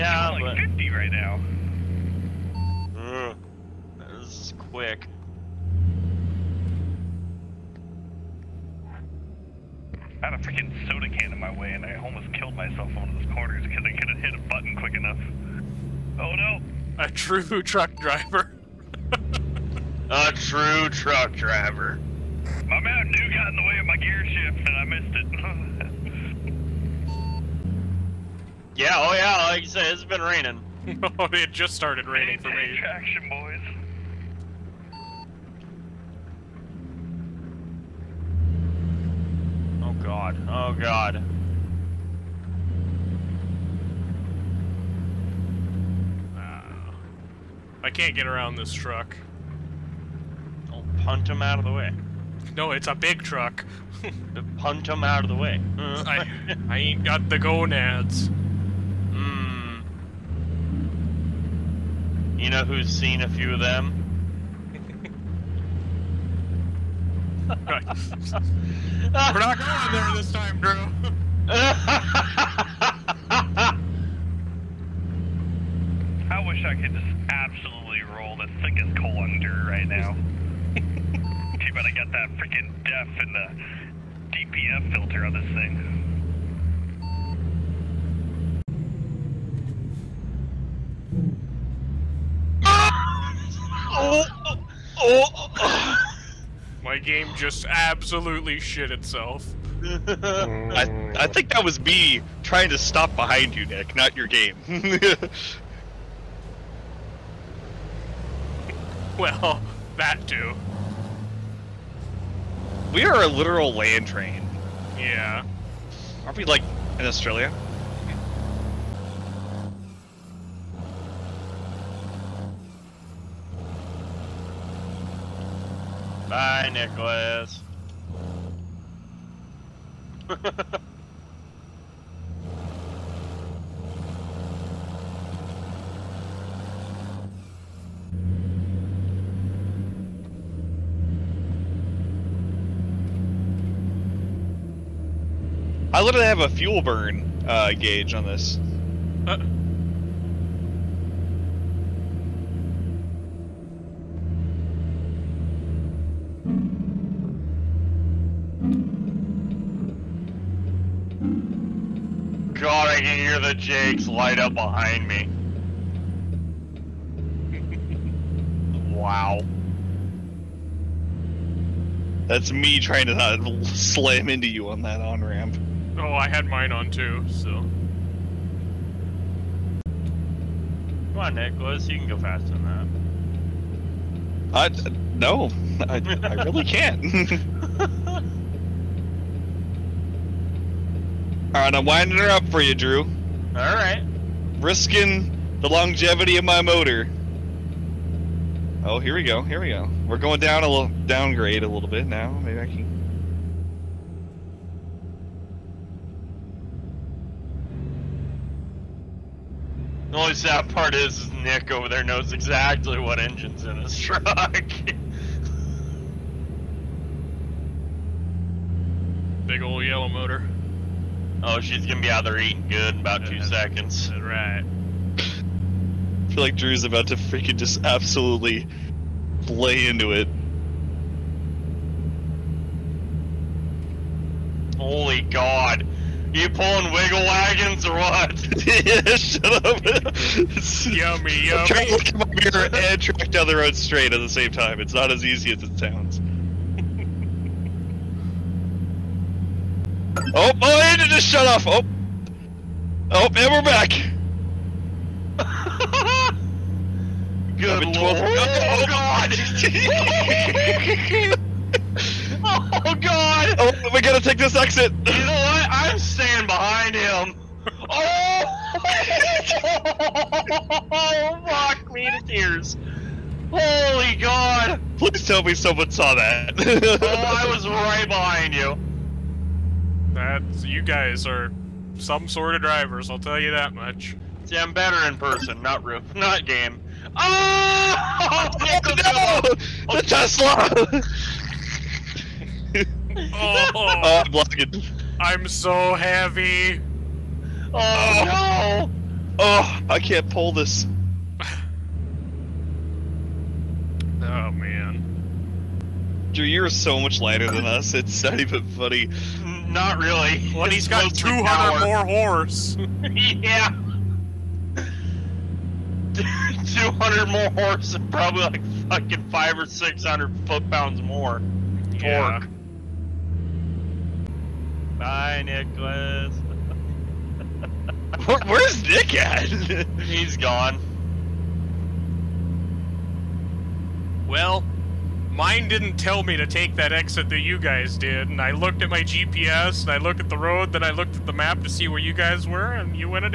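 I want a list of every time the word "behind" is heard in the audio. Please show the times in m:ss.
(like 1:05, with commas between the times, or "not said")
1:43, 2:44, 4:26, 4:38.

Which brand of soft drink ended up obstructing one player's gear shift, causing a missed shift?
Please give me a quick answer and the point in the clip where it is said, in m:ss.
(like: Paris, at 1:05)
Mountain Dew, at 0:22.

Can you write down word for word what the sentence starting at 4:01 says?
I'm trying to look at my and track down the road straight at the same time.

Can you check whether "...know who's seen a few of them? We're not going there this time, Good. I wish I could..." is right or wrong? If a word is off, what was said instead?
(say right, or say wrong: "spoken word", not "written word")
wrong: "Drew", not "Good".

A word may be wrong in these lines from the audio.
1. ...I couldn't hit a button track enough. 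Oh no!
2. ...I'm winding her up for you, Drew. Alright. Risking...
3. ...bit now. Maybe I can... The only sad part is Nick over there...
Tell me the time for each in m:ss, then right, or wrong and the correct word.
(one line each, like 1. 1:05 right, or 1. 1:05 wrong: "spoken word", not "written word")
1. 0:13 wrong: "quick", not "track"
2. 3:11 right
3. 3:21 right.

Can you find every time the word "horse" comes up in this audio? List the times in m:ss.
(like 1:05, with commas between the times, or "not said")
5:12, 5:17.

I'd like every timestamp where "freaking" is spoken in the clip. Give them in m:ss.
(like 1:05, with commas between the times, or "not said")
0:10, 1:22, 3:47.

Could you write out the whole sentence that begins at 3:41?
Oh, she's gonna be out there eating good in about two That's seconds.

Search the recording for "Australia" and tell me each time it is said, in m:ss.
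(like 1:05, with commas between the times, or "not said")
1:57.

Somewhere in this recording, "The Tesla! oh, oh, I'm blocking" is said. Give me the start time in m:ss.
4:49.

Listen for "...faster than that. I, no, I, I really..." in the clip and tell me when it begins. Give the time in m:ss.
3:02.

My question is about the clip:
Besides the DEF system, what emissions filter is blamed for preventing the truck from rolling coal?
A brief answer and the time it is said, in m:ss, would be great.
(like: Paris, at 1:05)
DPF filter, at 1:24.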